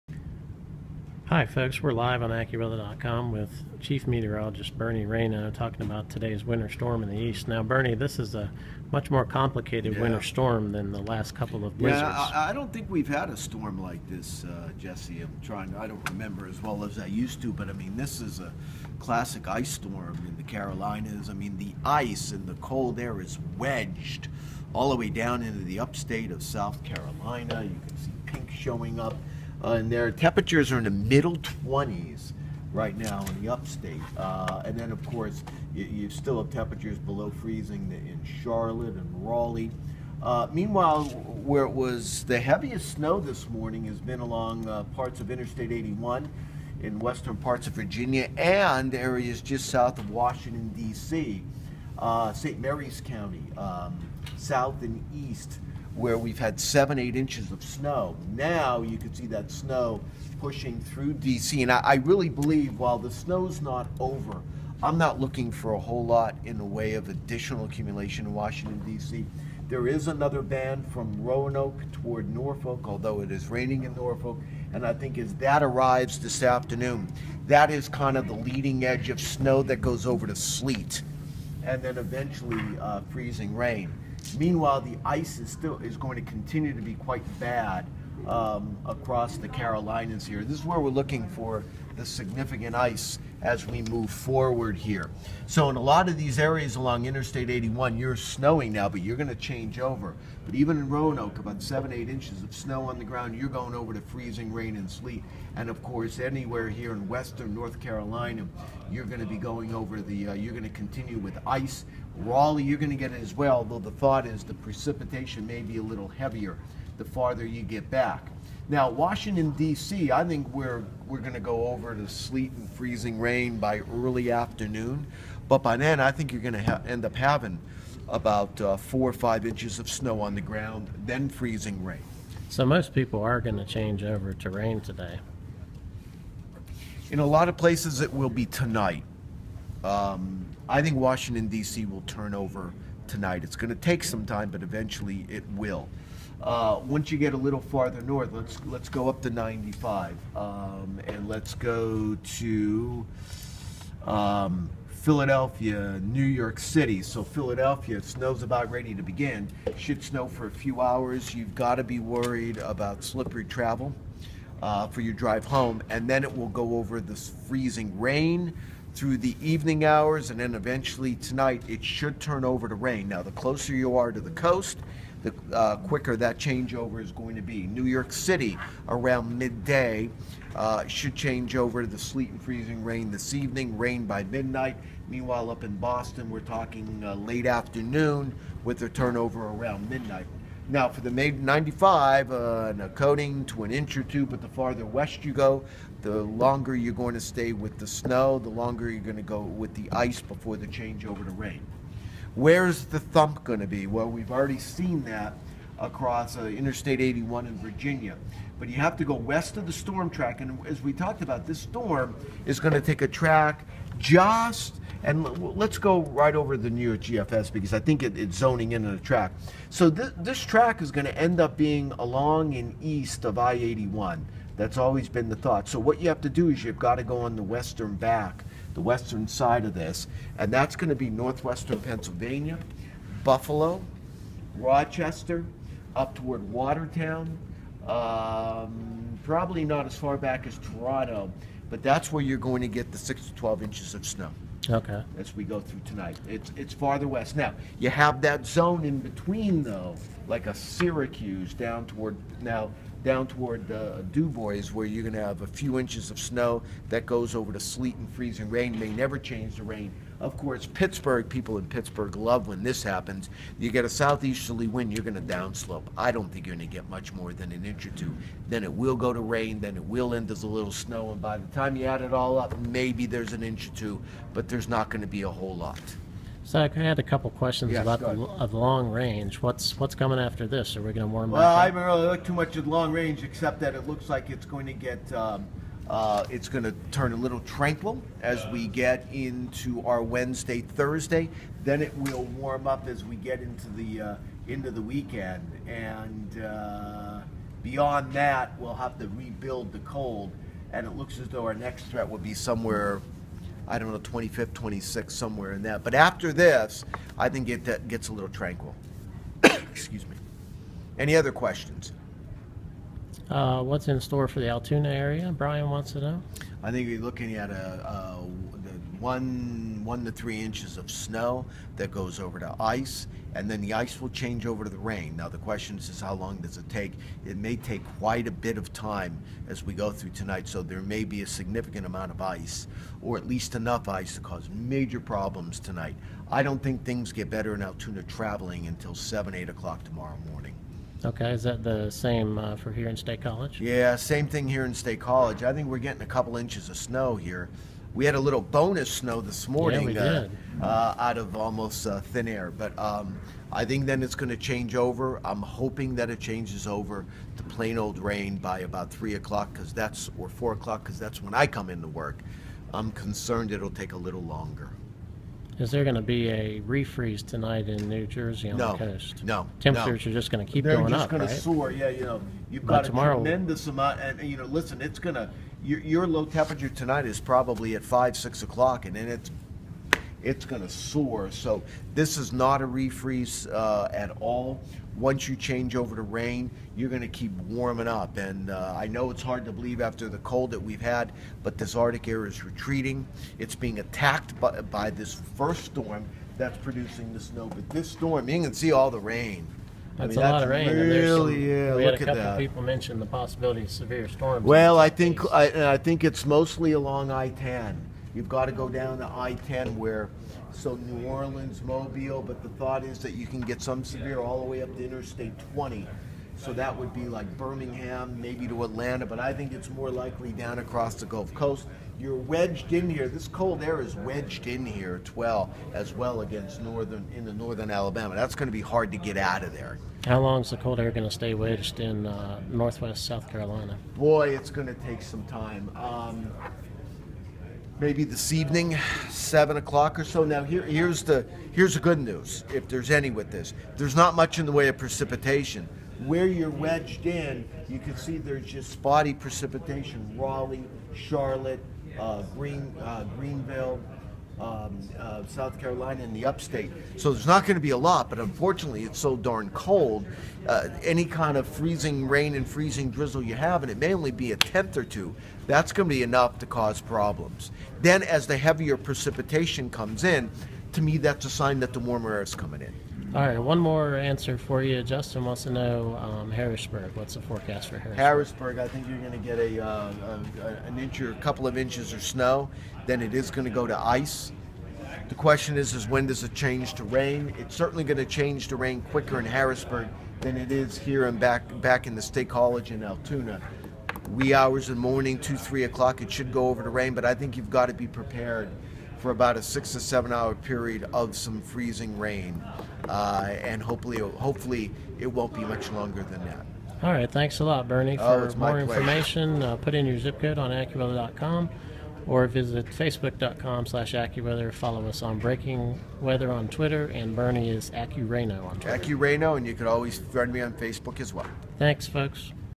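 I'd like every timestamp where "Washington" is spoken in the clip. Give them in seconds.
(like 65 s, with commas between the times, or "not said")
50 s, 68 s, 118 s, 140 s.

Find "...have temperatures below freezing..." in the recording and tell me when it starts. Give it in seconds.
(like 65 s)
36 s.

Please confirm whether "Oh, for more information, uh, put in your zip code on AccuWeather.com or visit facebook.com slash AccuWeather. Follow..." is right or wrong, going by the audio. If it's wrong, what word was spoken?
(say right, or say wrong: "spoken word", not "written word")
right.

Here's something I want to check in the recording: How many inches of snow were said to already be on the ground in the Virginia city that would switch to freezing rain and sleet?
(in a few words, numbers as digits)
7, 8 inches.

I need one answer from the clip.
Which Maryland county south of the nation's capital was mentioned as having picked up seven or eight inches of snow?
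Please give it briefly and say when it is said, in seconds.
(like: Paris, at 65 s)
St. Mary's County, at 52 s.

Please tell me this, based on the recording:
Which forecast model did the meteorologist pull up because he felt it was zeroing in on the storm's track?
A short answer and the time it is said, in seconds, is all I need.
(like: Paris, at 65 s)
New York GFS, at 216 s.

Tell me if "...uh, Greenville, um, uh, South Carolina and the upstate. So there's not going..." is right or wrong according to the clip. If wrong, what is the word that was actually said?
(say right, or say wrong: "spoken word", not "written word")
right.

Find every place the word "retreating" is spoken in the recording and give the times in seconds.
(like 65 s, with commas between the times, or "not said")
392 s.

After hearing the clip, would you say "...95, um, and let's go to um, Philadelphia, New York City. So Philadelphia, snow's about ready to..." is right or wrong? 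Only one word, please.
right.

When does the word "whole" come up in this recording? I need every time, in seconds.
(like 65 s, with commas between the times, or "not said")
65 s, 275 s.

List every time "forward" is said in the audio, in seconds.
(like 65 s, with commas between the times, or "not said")
94 s.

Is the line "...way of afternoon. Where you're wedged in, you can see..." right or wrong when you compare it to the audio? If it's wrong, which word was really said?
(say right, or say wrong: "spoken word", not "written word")
wrong: "precipitation", not "afternoon".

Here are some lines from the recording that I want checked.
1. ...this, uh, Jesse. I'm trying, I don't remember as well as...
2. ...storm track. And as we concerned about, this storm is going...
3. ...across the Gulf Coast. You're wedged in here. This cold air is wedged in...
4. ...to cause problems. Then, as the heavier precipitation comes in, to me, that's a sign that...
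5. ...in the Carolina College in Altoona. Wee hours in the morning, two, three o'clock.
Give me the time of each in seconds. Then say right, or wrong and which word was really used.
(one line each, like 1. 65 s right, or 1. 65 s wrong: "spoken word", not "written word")
1. 14 s right
2. 209 s wrong: "talked", not "concerned"
3. 420 s right
4. 466 s right
5. 491 s wrong: "State", not "Carolina".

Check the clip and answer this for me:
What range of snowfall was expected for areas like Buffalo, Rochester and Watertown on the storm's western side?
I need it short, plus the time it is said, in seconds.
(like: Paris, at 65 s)
6 to 12 inches, at 242 s.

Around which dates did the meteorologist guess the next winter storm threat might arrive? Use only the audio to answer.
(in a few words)
25th, 26th.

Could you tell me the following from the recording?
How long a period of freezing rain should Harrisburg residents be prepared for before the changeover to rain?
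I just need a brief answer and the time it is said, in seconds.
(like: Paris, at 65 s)
6 to 7 hours, at 499 s.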